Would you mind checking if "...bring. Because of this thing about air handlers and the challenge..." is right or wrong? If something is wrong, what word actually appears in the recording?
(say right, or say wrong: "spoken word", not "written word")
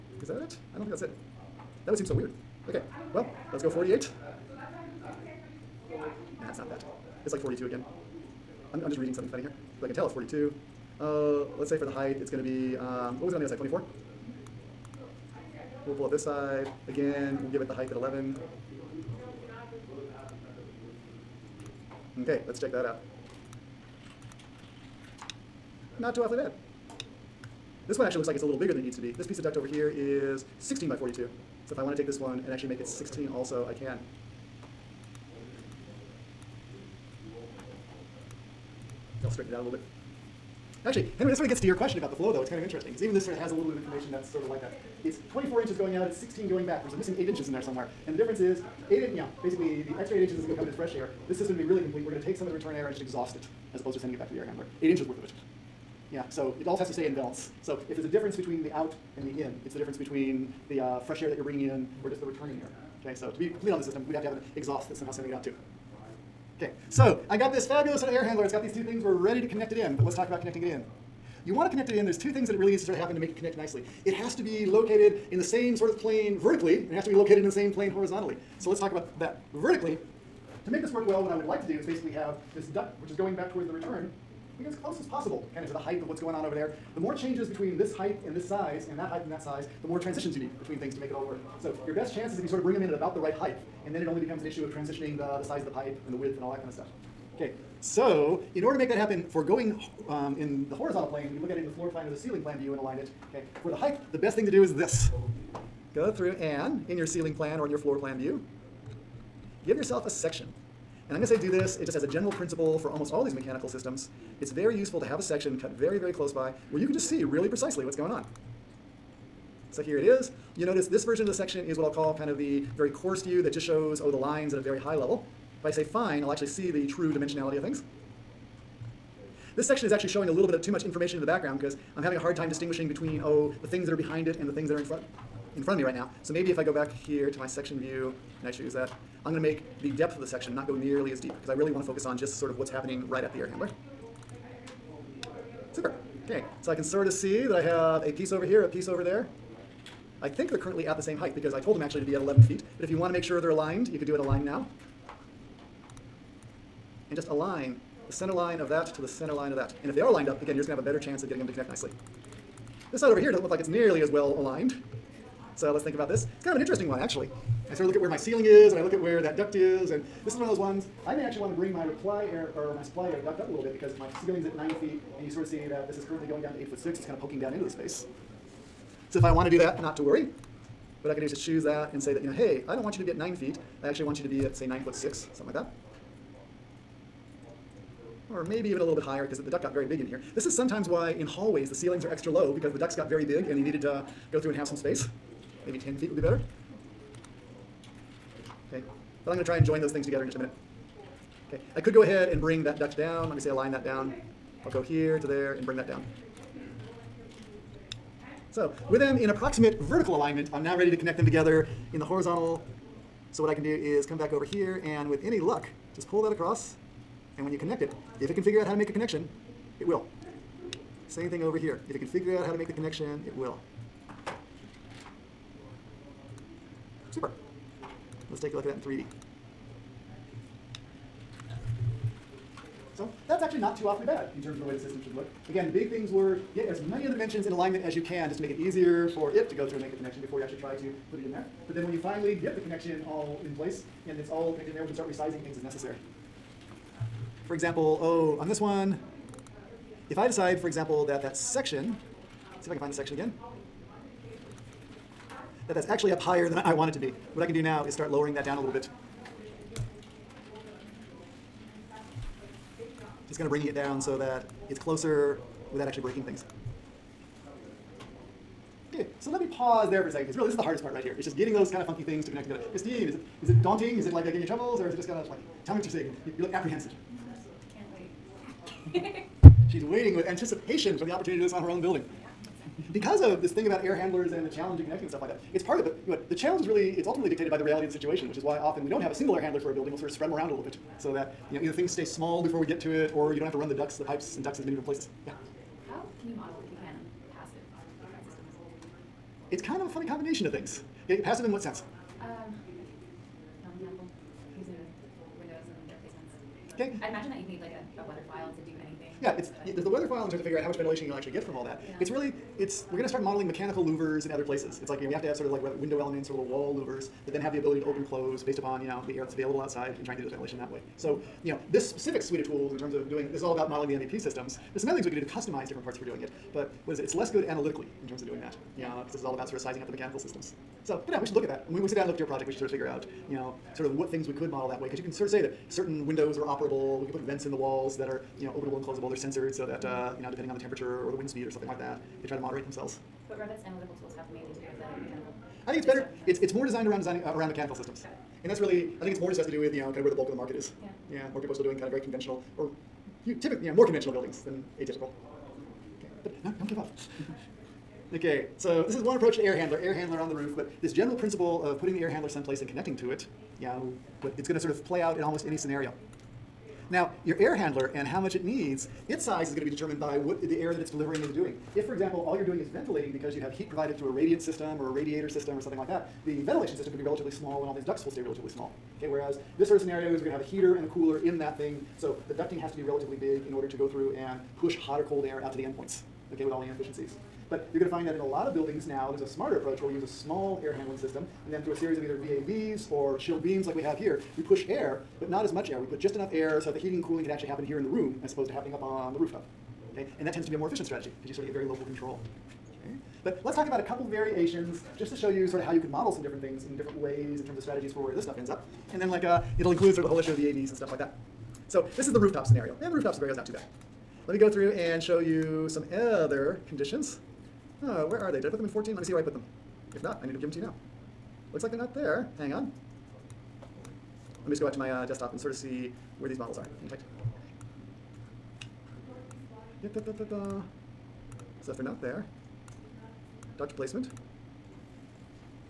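wrong: "building", not "bring".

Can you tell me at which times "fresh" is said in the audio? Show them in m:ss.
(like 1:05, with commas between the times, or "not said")
0:50, 1:00.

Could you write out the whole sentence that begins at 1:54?
It's very useful to have a section cut very, very close by where you can just see really precisely what's going on.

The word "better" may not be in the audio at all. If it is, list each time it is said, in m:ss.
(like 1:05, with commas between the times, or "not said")
2:40, 3:16, 5:45.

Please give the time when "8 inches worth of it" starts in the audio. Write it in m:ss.
0:54.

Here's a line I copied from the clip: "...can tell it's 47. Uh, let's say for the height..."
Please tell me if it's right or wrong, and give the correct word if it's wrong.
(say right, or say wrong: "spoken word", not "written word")
wrong: "42", not "47".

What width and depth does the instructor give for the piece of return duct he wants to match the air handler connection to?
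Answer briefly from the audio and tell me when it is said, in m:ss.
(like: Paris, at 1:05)
16 by 42, at 0:30.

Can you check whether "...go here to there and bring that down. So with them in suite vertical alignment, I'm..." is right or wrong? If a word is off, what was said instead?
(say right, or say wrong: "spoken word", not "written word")
wrong: "approximate", not "suite".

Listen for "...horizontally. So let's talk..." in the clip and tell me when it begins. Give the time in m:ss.
1:17.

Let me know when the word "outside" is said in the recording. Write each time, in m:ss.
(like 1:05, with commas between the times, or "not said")
5:19.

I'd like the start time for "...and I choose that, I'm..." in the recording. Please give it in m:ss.
2:18.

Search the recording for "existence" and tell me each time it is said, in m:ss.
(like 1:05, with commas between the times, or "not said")
not said.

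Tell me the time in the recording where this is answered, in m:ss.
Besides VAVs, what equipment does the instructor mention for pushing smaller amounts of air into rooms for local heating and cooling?
6:33.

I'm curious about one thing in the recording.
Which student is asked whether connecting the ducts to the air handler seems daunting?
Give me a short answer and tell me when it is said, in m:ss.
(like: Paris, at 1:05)
Christine, at 4:32.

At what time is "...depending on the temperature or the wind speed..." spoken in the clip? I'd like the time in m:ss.
5:40.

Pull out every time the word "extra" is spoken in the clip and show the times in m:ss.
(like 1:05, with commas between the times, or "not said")
0:49, 3:12.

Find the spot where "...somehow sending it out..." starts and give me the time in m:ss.
1:04.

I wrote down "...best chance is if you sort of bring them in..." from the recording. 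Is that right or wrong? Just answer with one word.
right.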